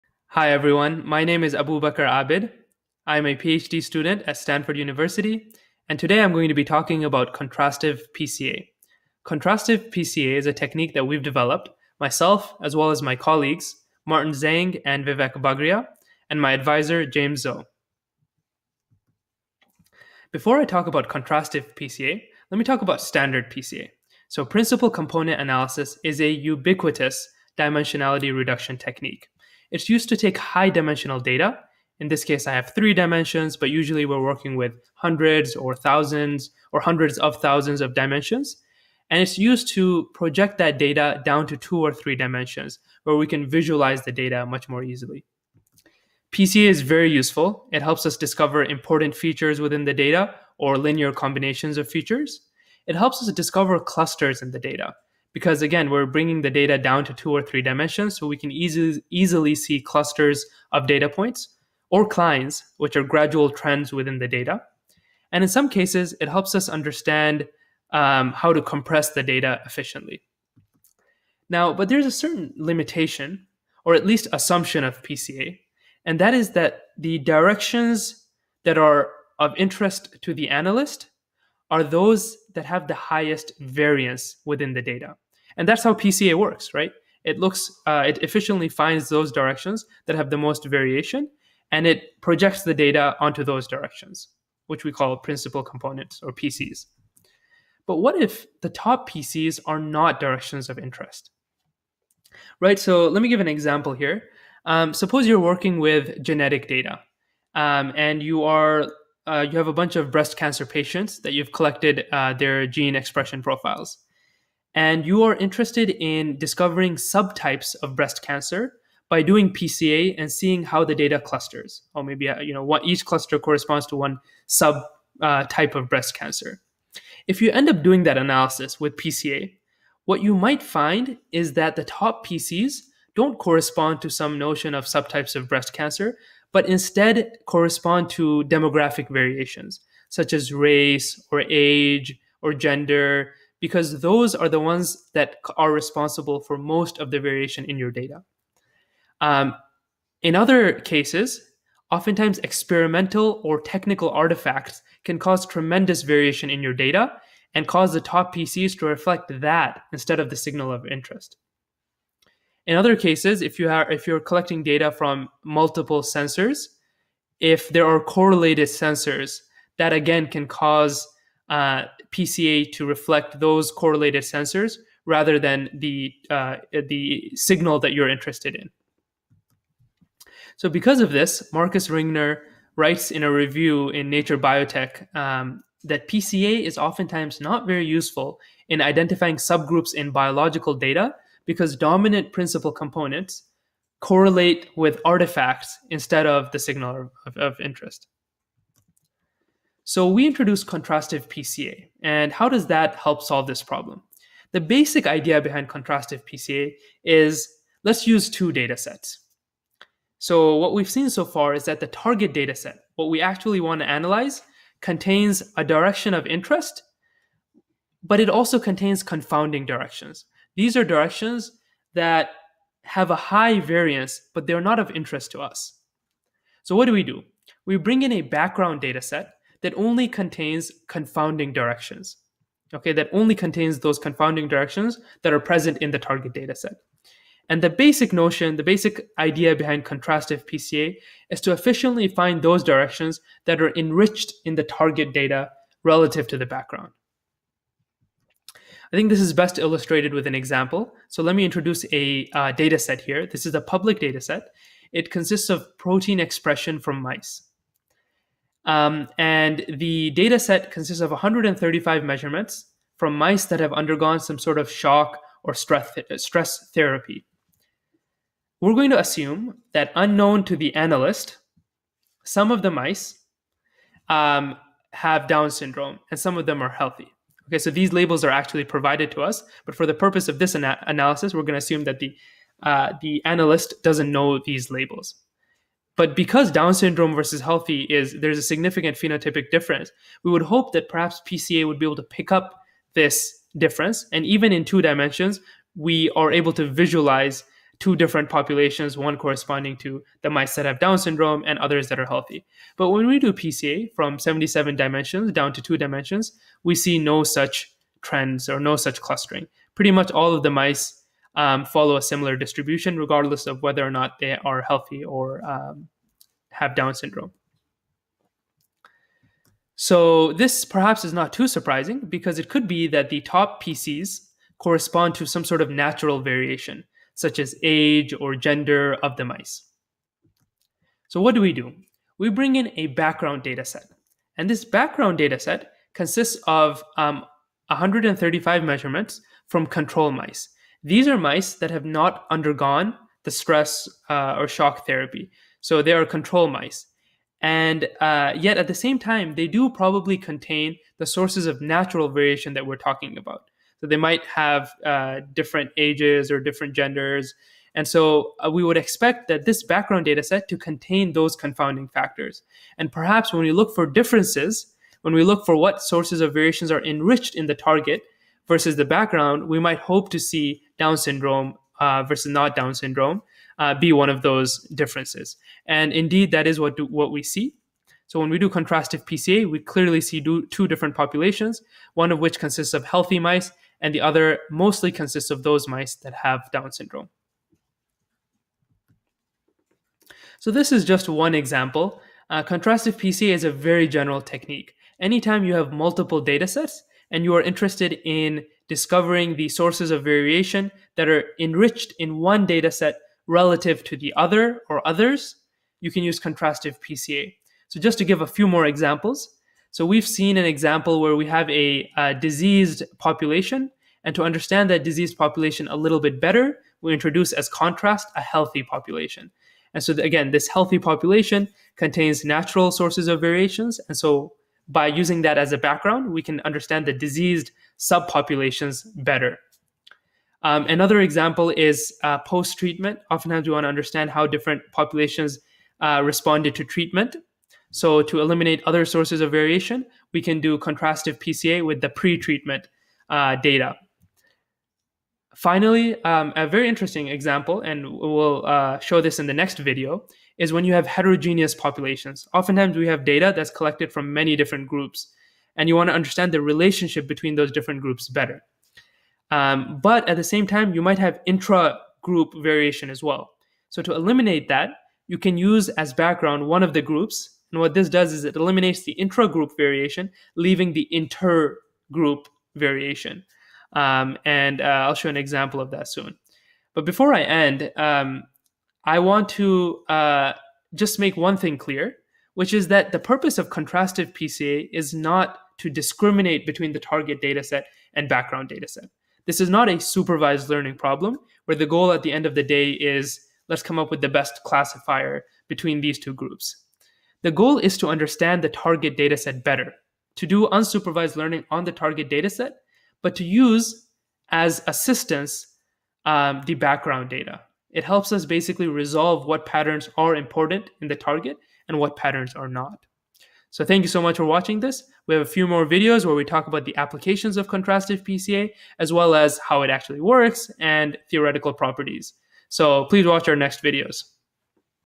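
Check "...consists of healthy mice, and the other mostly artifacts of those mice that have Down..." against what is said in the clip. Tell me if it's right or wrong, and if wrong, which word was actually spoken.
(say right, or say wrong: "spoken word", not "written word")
wrong: "consists", not "artifacts".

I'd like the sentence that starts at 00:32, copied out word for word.
In this case, I have three dimensions, but usually we're working with hundreds or thousands or hundreds of thousands of dimensions.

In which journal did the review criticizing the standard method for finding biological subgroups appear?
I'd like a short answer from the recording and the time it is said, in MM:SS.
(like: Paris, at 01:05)
Nature Biotech, at 03:04.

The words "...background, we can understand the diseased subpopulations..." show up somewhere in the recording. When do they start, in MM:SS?
07:05.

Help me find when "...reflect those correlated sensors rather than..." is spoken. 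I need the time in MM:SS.
02:52.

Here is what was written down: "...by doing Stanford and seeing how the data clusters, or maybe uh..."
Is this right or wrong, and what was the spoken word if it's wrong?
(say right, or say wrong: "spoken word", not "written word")
wrong: "PCA", not "Stanford".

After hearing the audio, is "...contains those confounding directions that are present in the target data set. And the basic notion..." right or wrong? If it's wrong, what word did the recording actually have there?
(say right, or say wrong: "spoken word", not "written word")
right.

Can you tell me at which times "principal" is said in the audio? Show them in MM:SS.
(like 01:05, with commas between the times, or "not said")
00:24, 01:35, 03:12.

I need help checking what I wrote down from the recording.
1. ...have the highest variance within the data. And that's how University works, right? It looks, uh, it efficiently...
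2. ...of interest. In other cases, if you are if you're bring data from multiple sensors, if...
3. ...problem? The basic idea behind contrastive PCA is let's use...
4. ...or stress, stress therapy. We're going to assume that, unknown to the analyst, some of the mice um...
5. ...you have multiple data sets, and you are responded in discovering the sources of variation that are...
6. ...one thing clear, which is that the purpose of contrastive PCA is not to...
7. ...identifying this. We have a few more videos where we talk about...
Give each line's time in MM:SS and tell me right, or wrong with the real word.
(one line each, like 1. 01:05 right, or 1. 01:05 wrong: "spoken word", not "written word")
1. 01:22 wrong: "PCA", not "University"
2. 02:40 wrong: "collecting", not "bring"
3. 03:23 right
4. 04:25 right
5. 06:35 wrong: "interested", not "responded"
6. 08:01 right
7. 08:34 wrong: "watching", not "identifying".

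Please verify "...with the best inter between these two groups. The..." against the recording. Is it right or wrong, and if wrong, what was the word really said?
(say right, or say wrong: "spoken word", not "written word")
wrong: "classifier", not "inter".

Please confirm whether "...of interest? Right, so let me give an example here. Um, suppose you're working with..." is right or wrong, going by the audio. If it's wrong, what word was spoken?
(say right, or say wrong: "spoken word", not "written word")
right.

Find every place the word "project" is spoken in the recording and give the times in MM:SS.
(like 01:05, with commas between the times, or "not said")
00:40, 01:32.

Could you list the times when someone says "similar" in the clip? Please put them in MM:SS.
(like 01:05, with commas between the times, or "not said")
05:12.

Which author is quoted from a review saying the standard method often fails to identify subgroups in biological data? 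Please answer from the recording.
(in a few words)
Markus Ringner.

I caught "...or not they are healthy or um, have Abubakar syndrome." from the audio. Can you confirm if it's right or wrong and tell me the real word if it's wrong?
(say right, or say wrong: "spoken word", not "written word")
wrong: "Down", not "Abubakar".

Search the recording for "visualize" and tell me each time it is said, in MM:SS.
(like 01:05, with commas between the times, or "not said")
00:43, 04:56.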